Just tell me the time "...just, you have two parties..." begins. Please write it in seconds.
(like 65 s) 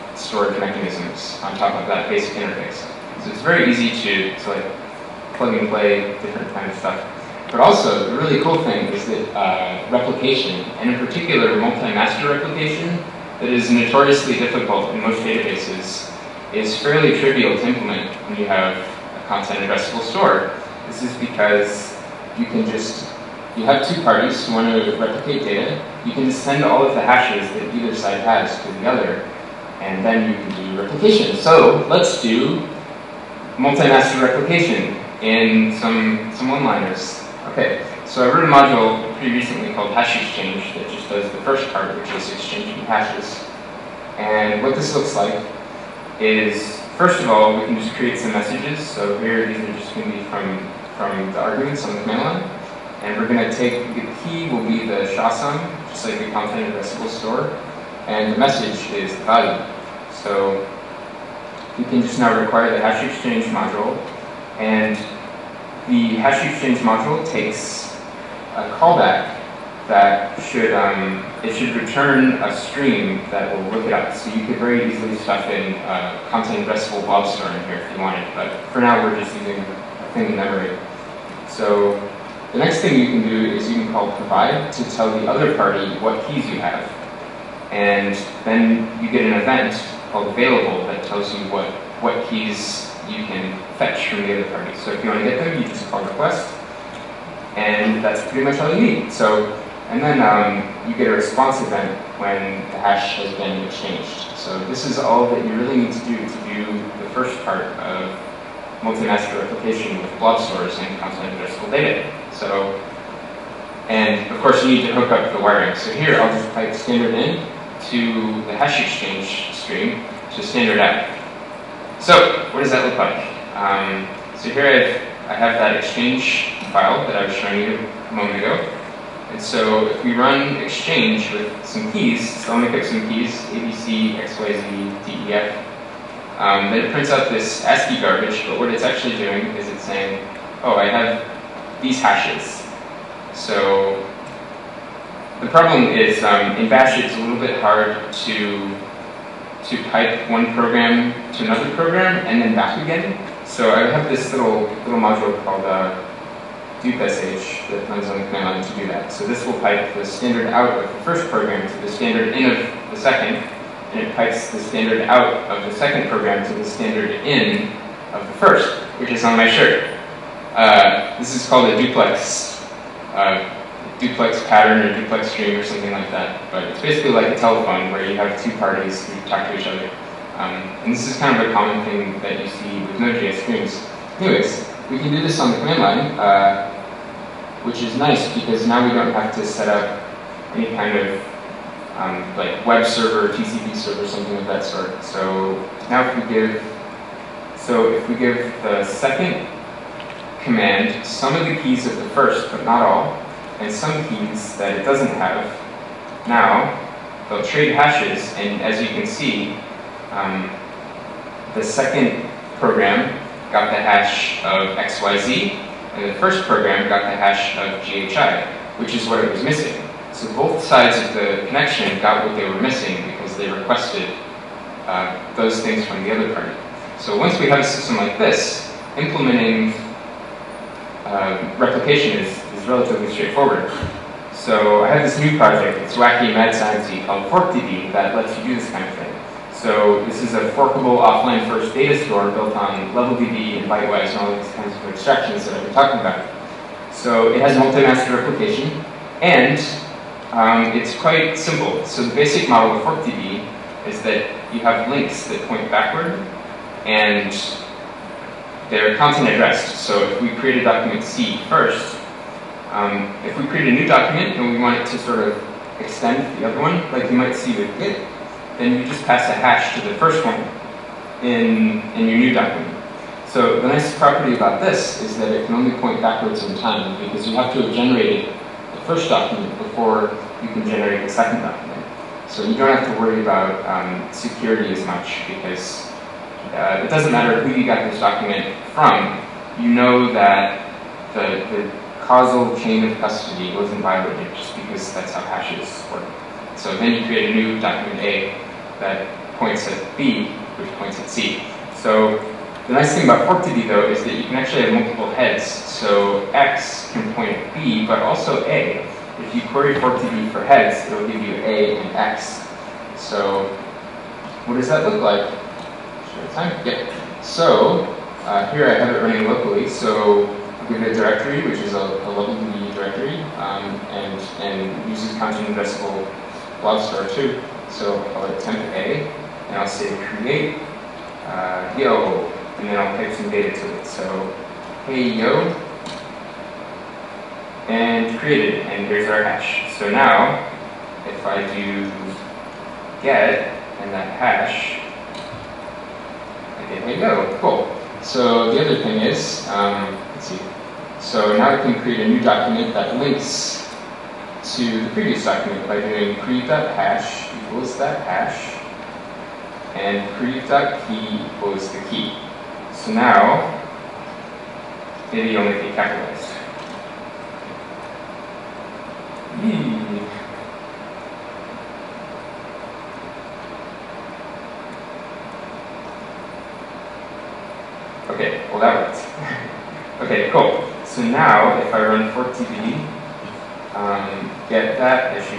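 22 s.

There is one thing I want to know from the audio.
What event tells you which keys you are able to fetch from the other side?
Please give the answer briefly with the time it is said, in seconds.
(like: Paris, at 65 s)
available, at 90 s.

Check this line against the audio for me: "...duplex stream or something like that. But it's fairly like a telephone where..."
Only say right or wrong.
wrong.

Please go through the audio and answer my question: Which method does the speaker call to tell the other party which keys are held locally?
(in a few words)
provide.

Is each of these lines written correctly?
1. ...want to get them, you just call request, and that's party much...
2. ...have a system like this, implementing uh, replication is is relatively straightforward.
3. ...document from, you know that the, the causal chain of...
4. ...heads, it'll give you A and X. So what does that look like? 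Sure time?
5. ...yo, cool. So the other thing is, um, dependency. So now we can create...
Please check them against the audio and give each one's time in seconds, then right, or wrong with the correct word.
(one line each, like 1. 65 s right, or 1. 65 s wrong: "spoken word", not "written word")
1. 95 s wrong: "pretty", not "party"
2. 227 s right
3. 288 s right
4. 310 s right
5. 347 s right.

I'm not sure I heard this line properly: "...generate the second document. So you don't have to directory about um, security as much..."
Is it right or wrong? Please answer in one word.
wrong.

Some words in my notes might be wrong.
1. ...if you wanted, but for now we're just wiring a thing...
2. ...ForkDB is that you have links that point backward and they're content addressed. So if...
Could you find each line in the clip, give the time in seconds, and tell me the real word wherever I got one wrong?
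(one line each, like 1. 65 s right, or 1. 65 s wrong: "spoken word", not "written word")
1. 77 s wrong: "using", not "wiring"
2. 252 s right.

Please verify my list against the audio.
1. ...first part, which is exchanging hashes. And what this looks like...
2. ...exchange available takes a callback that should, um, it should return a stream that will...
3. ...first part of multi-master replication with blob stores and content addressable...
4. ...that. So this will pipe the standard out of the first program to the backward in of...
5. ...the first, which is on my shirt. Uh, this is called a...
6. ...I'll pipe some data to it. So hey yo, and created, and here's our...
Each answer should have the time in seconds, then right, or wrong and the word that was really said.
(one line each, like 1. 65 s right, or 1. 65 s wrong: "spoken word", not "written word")
1. 41 s right
2. 66 s wrong: "module", not "available"
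3. 107 s right
4. 158 s wrong: "standard", not "backward"
5. 168 s right
6. 332 s right.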